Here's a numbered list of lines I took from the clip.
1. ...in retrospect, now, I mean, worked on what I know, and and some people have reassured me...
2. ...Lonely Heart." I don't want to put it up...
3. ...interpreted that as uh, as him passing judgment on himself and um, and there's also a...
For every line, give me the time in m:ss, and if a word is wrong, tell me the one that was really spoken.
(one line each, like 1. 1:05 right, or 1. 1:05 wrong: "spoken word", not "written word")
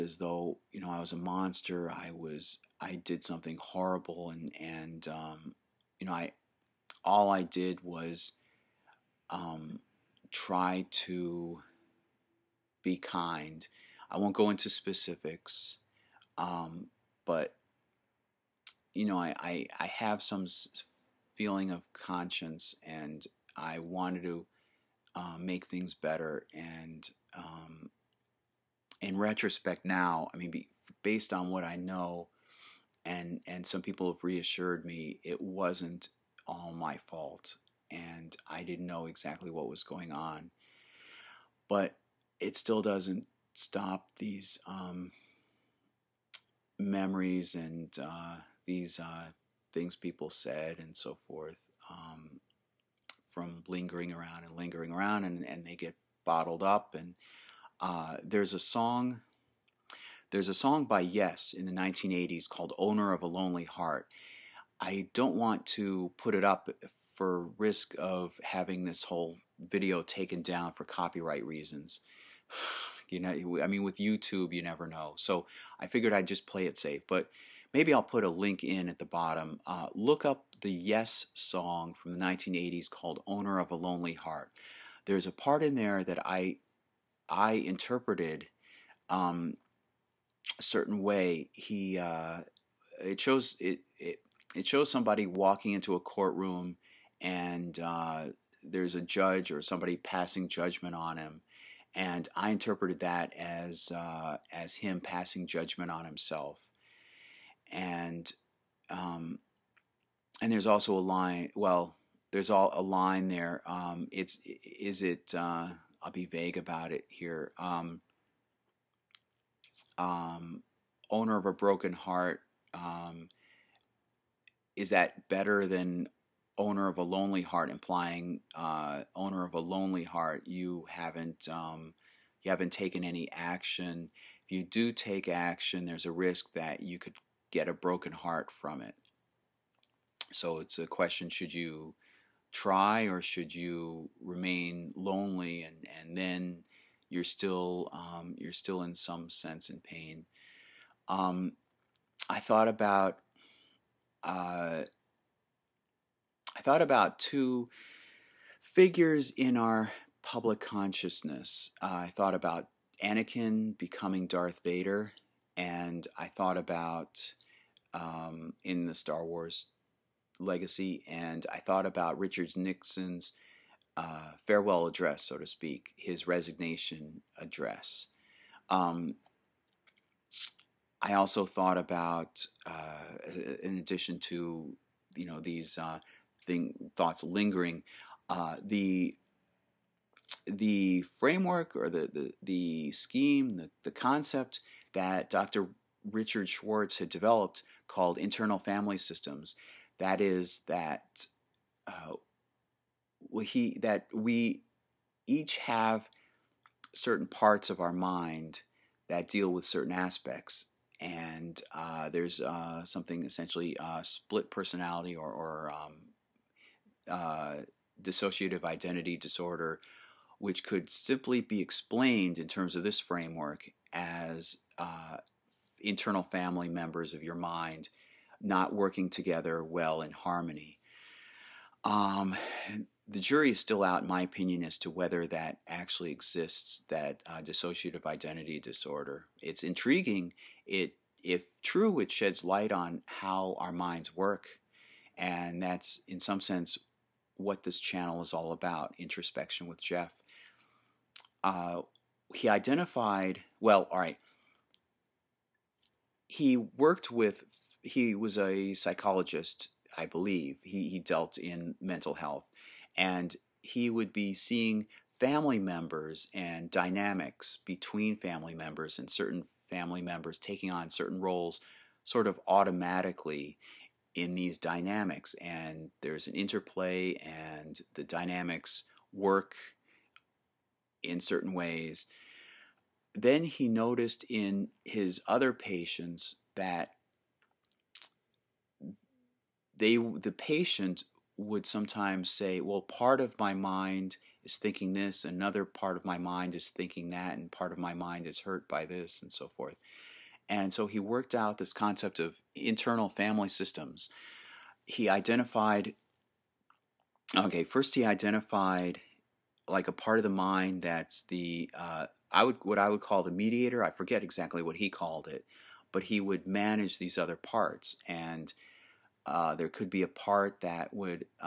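1. 0:29 wrong: "based", not "worked"
2. 1:03 right
3. 1:42 right.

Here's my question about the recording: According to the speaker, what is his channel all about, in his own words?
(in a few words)
Introspection with Jeff.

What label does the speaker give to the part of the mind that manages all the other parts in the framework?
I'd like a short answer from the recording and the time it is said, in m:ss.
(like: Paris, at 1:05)
mediator, at 5:13.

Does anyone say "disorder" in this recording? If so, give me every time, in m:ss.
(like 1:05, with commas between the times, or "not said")
3:39, 3:58.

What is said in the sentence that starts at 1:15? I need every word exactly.
So I figured I'd just play it safe.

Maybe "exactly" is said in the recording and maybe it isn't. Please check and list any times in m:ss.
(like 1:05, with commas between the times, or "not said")
0:39, 5:14.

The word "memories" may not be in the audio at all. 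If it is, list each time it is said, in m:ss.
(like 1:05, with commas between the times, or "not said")
0:46.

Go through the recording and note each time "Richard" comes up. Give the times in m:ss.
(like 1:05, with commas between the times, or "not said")
2:52, 3:16.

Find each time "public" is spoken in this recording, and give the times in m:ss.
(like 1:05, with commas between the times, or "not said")
2:40.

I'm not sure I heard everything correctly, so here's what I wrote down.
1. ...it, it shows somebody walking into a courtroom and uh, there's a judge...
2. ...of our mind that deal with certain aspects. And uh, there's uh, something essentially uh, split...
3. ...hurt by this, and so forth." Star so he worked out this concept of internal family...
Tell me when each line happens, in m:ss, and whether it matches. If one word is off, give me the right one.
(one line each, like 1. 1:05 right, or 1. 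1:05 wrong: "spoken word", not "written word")
1. 1:33 right
2. 3:27 right
3. 4:58 wrong: "And", not "Star".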